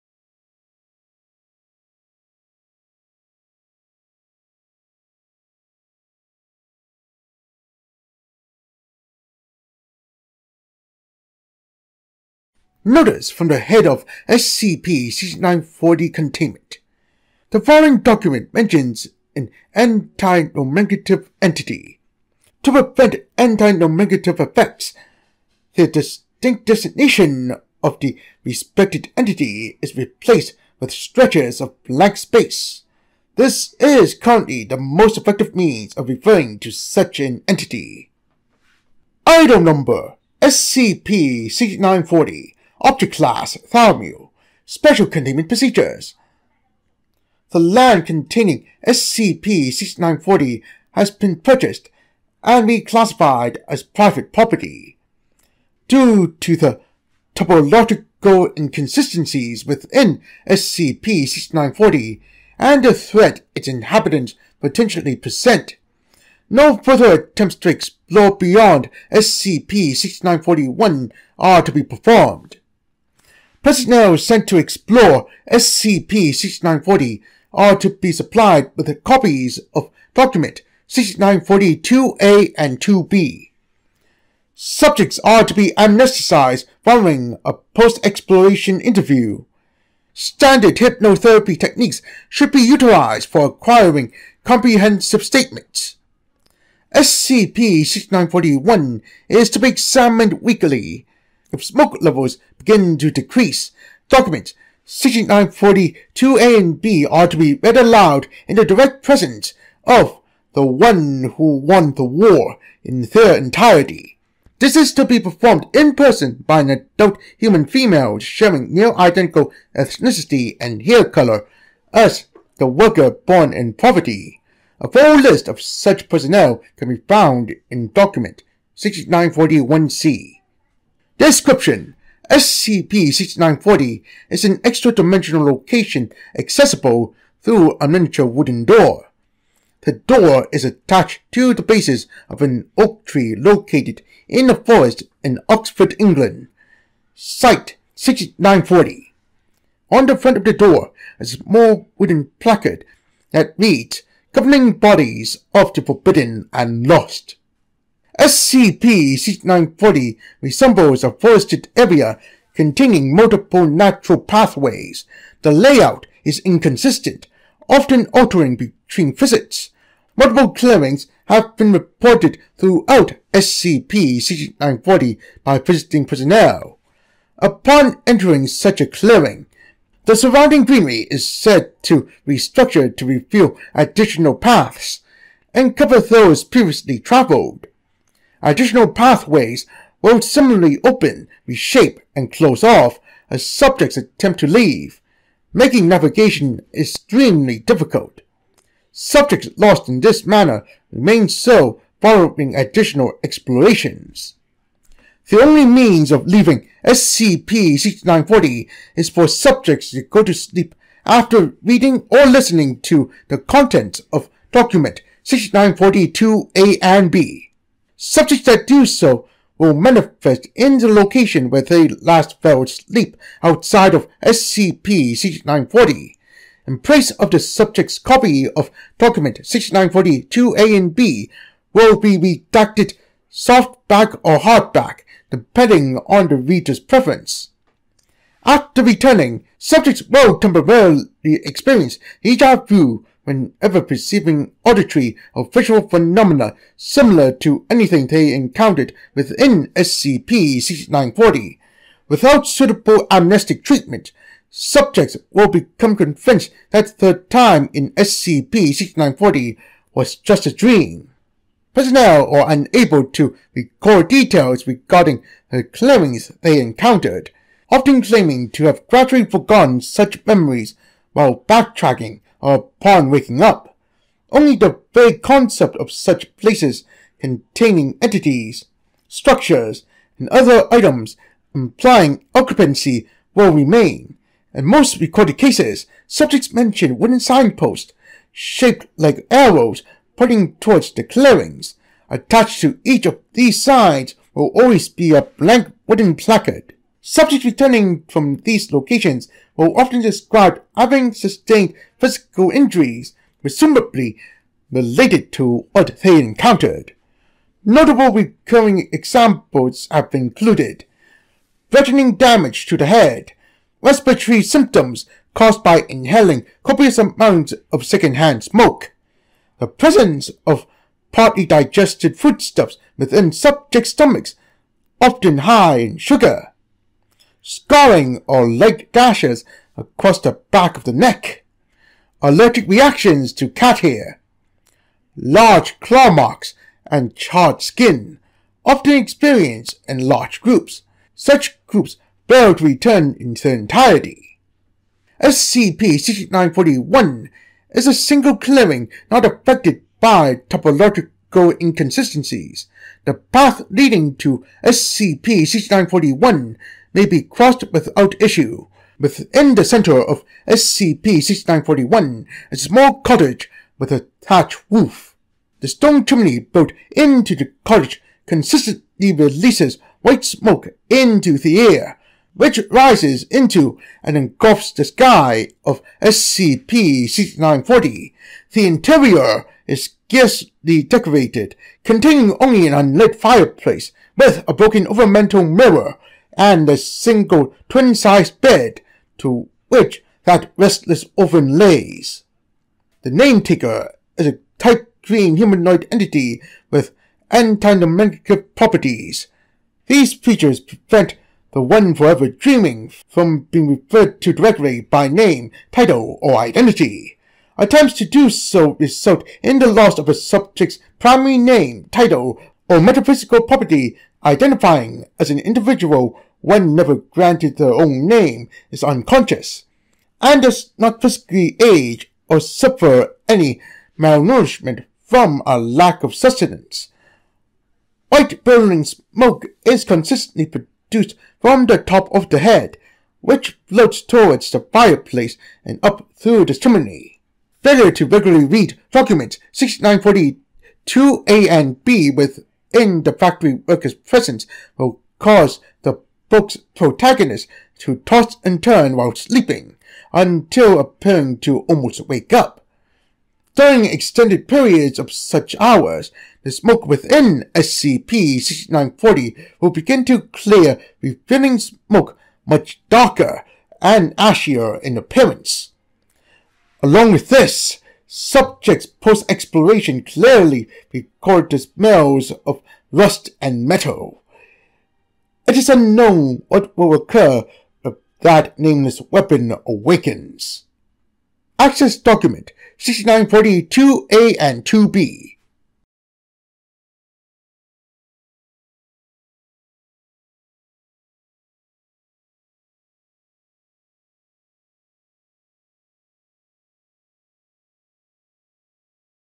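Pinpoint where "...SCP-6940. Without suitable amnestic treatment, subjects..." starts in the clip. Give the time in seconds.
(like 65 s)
249 s.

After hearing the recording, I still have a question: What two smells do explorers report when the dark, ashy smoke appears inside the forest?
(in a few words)
rust and metal.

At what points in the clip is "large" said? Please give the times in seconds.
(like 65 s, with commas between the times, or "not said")
335 s, 340 s.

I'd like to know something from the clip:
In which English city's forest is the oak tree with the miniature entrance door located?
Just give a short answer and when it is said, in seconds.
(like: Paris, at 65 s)
Oxford, at 145 s.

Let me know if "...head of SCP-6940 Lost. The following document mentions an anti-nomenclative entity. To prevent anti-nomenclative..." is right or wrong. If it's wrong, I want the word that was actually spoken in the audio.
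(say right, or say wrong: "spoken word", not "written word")
wrong: "Containment", not "Lost".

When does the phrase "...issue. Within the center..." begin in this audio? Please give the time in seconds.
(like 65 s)
358 s.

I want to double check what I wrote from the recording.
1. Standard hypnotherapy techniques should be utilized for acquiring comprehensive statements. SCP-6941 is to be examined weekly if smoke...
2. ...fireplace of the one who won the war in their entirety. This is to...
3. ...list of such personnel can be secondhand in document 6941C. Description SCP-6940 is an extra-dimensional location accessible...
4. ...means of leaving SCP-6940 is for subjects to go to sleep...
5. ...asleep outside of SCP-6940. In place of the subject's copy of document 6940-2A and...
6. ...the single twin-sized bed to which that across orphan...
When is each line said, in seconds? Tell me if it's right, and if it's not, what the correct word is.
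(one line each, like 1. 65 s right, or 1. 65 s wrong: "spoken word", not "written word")
1. 90 s right
2. 109 s wrong: "presence", not "fireplace"
3. 125 s wrong: "found", not "secondhand"
4. 205 s right
5. 222 s right
6. 386 s wrong: "restless", not "across".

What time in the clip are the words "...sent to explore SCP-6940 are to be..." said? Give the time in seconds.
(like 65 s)
74 s.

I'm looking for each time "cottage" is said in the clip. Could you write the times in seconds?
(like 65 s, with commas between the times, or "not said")
363 s, 367 s.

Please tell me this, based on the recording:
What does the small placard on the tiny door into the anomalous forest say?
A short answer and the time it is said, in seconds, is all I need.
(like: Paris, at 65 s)
Governing Bodies of the Forbidden and Lost, at 154 s.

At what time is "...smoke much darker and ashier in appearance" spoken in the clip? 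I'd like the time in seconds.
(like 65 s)
461 s.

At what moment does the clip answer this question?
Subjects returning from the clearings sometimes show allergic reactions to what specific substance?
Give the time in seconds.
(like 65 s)
333 s.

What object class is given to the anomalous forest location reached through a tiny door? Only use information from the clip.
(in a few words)
Thalmu.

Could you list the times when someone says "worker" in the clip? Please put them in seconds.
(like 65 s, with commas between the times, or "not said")
122 s, 443 s.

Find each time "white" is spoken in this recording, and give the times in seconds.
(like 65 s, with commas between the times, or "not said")
370 s, 428 s.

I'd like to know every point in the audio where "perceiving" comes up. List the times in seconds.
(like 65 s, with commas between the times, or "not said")
243 s.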